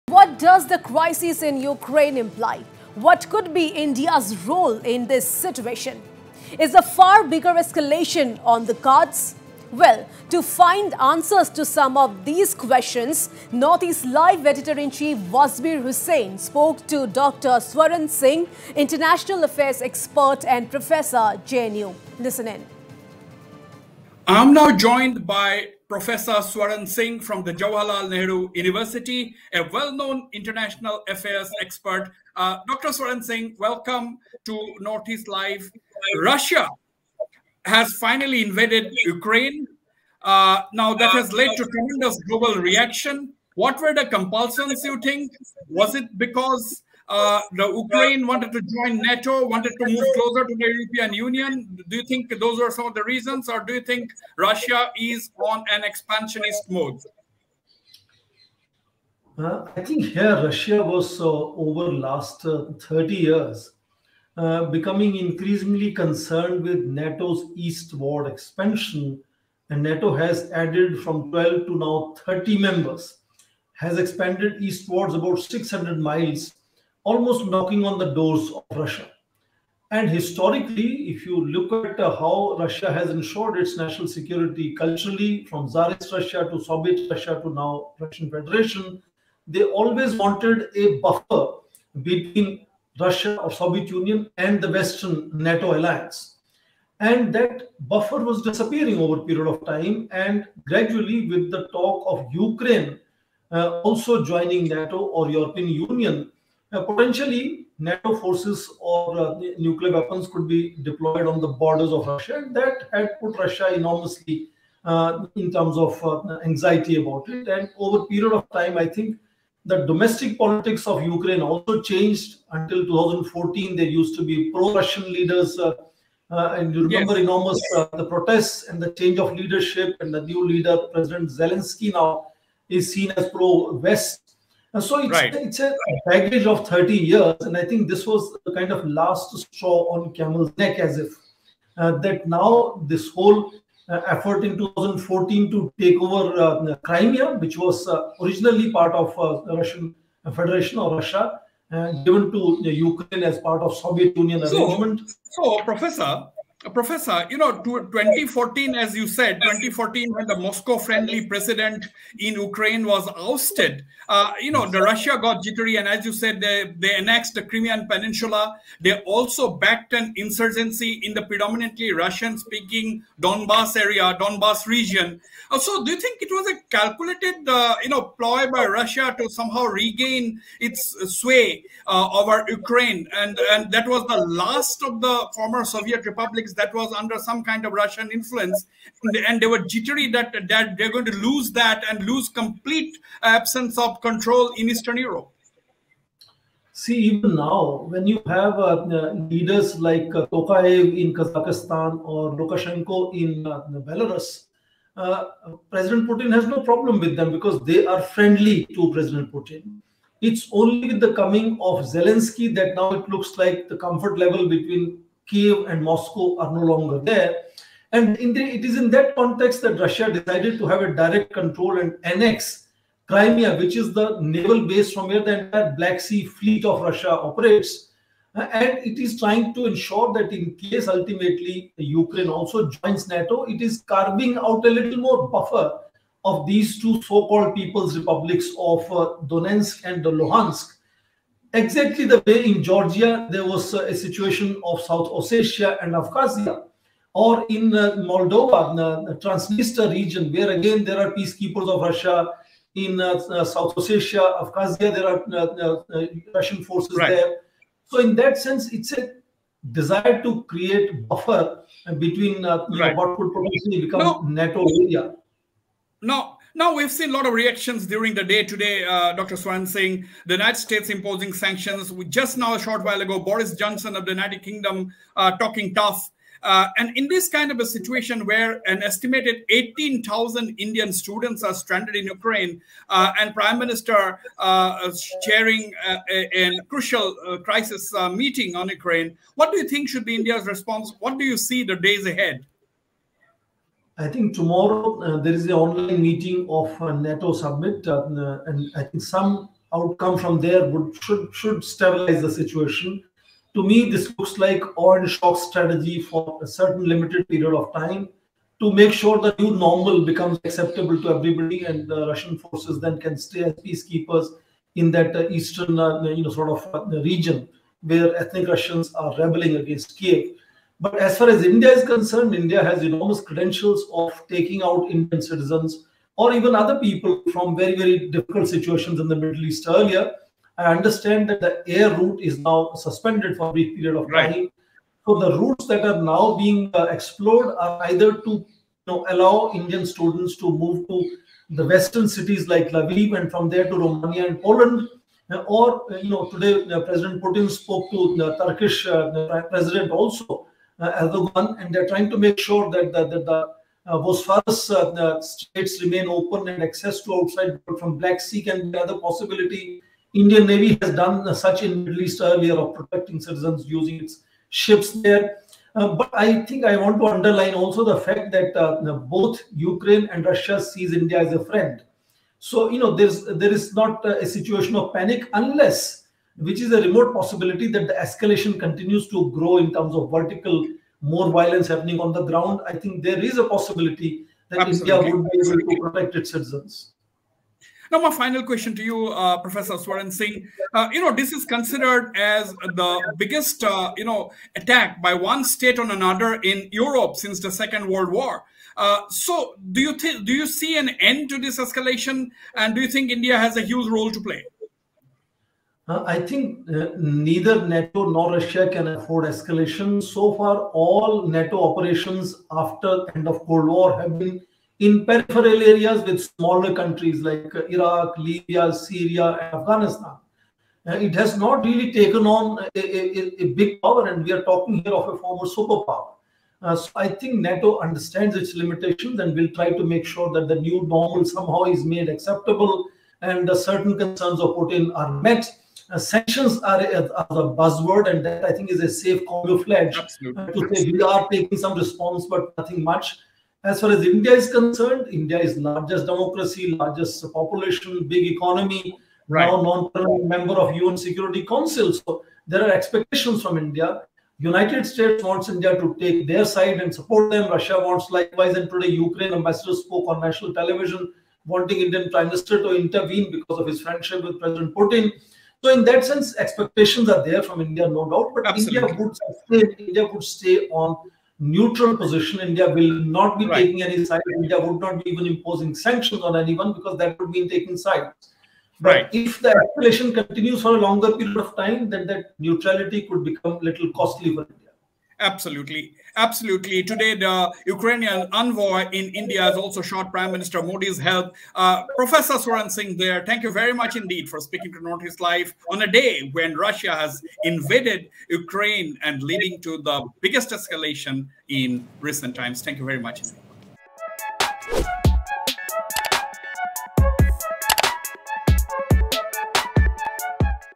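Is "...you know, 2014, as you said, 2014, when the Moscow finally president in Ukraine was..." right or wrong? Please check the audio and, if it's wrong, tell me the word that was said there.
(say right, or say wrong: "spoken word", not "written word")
wrong: "friendly", not "finally".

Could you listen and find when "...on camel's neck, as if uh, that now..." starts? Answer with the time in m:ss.
2:19.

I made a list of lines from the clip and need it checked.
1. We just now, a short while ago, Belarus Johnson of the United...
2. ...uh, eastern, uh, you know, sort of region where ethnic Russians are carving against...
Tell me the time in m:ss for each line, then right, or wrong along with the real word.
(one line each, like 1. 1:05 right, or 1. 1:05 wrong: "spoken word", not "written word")
1. 4:31 wrong: "Boris", not "Belarus"
2. 5:15 wrong: "rebelling", not "carving".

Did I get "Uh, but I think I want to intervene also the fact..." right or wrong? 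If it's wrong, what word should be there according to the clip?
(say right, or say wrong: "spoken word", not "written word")
wrong: "underline", not "intervene".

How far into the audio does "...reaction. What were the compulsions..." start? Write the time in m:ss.
0:42.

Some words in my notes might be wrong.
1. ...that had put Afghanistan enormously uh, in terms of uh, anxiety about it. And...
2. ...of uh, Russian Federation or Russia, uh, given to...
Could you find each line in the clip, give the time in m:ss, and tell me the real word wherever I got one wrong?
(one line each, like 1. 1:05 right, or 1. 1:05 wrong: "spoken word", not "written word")
1. 1:52 wrong: "Russia", not "Afghanistan"
2. 2:28 right.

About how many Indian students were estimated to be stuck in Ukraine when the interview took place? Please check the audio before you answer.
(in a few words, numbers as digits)
18,000.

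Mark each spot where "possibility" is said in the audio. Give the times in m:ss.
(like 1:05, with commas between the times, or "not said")
5:58, 6:17, 6:23.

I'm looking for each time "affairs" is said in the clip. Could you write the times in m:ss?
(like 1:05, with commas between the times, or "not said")
0:19, 0:31.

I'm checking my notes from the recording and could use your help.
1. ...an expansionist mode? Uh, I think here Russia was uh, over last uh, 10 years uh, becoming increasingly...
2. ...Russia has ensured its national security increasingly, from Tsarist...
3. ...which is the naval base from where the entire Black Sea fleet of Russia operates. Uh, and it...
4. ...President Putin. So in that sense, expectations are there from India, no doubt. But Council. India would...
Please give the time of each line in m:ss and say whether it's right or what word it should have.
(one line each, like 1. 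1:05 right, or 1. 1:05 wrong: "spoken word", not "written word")
1. 0:55 wrong: "30", not "10"
2. 1:22 wrong: "culturally", not "increasingly"
3. 3:43 right
4. 7:44 wrong: "Absolutely", not "Council".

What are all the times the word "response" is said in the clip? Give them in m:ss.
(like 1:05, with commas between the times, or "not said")
4:50, 7:21.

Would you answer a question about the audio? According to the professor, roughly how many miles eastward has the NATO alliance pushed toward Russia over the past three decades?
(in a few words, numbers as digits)
600 miles.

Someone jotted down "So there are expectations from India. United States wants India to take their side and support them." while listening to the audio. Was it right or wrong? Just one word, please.
right.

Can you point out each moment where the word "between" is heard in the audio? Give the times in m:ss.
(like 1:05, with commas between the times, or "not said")
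1:32, 3:34, 4:21.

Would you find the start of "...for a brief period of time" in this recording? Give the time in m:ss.
5:33.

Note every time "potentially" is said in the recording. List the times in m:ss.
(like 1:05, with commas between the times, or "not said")
1:46, 4:23.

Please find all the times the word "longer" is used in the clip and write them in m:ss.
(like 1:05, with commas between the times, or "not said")
3:36, 8:00.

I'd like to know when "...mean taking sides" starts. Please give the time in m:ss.
7:57.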